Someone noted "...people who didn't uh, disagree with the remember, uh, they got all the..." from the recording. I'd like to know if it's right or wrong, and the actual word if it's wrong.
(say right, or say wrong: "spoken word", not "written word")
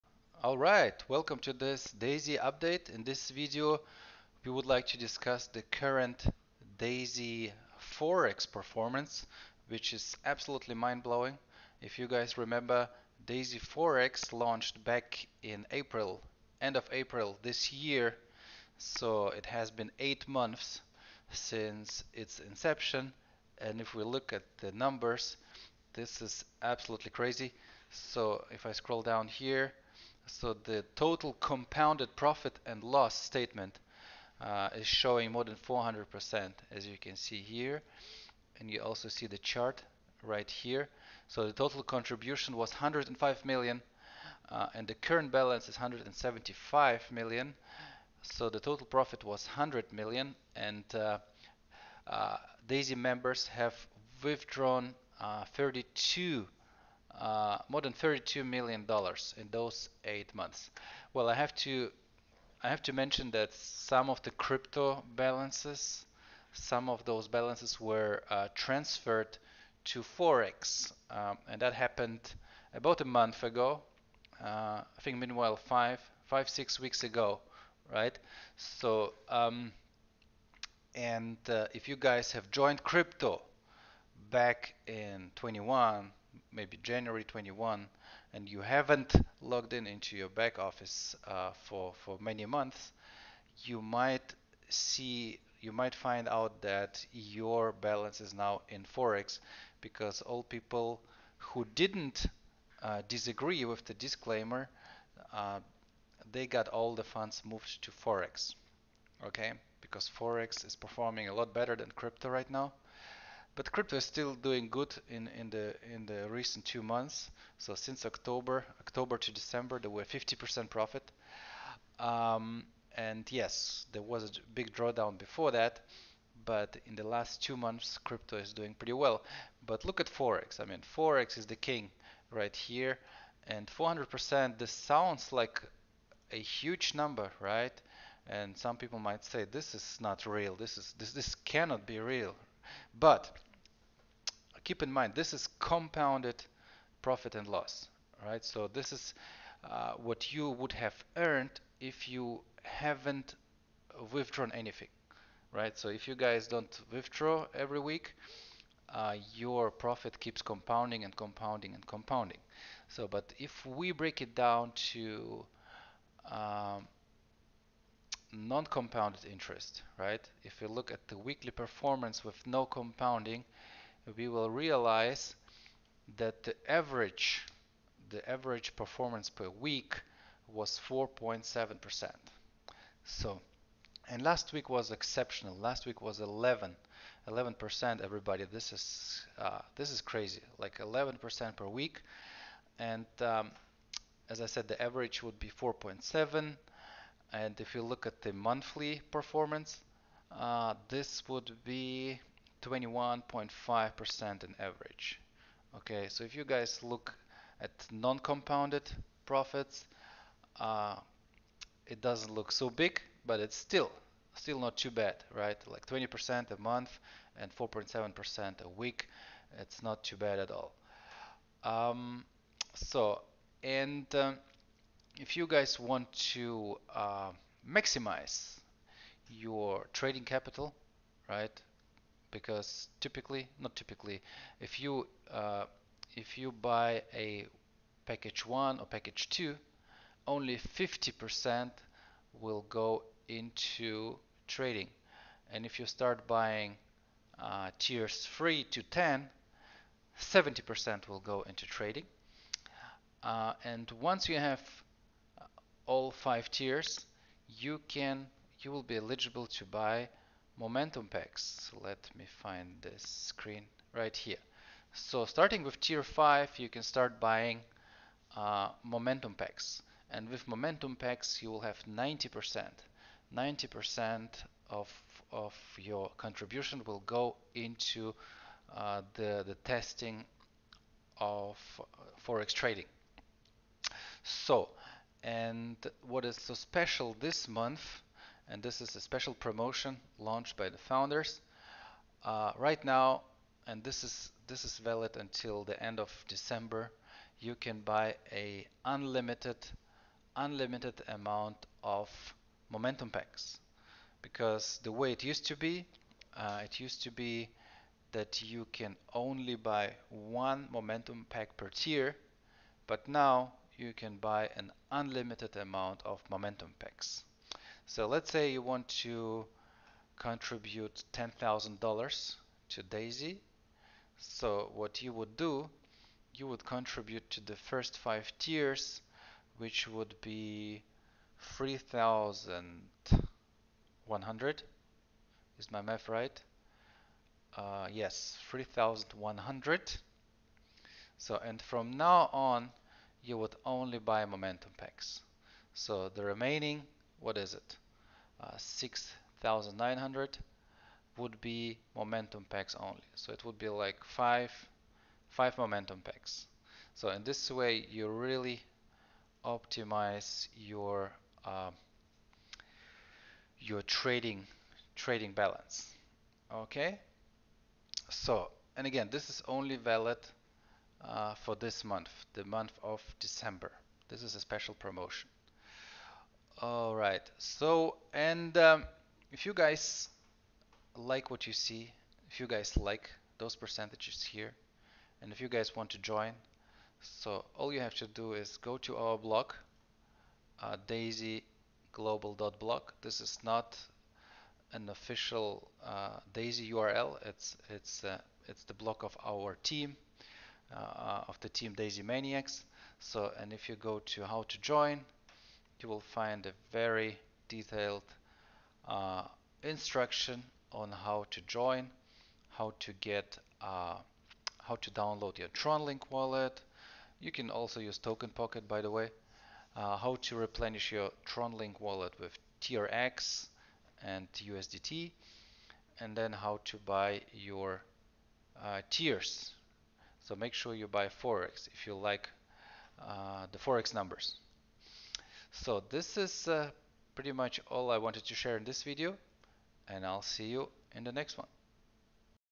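wrong: "disclaimer", not "remember".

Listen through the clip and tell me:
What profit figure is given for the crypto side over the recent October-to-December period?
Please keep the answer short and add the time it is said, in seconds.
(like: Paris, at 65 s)
50%, at 120 s.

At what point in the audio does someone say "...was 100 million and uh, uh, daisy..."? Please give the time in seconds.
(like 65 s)
49 s.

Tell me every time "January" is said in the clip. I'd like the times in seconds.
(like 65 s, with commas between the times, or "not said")
86 s.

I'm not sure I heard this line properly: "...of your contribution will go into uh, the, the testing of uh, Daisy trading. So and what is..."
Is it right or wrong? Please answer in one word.
wrong.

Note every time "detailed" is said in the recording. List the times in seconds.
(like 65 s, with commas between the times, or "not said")
407 s.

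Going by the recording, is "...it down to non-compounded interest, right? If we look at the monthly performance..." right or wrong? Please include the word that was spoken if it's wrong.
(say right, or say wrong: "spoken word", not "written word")
wrong: "weekly", not "monthly".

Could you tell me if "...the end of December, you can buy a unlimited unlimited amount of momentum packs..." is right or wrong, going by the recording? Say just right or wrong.
right.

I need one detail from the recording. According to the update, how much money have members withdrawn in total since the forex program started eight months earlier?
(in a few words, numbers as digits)
more than 32 million dollars.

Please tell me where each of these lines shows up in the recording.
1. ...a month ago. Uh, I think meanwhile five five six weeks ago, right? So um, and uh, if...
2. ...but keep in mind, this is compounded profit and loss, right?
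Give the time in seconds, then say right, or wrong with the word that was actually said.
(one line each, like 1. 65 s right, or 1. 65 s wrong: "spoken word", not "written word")
1. 73 s right
2. 142 s right.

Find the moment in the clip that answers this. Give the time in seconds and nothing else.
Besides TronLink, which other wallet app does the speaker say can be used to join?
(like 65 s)
417 s.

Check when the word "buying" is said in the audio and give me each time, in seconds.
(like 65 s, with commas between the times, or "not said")
246 s, 267 s.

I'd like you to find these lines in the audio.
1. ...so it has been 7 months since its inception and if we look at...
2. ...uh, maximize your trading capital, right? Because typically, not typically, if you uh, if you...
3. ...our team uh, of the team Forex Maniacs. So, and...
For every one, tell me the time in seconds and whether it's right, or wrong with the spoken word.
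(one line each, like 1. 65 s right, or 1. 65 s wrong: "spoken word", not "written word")
1. 18 s wrong: "8", not "7"
2. 226 s right
3. 399 s wrong: "Daisy", not "Forex".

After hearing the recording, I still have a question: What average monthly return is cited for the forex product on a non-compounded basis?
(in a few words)
21.5%.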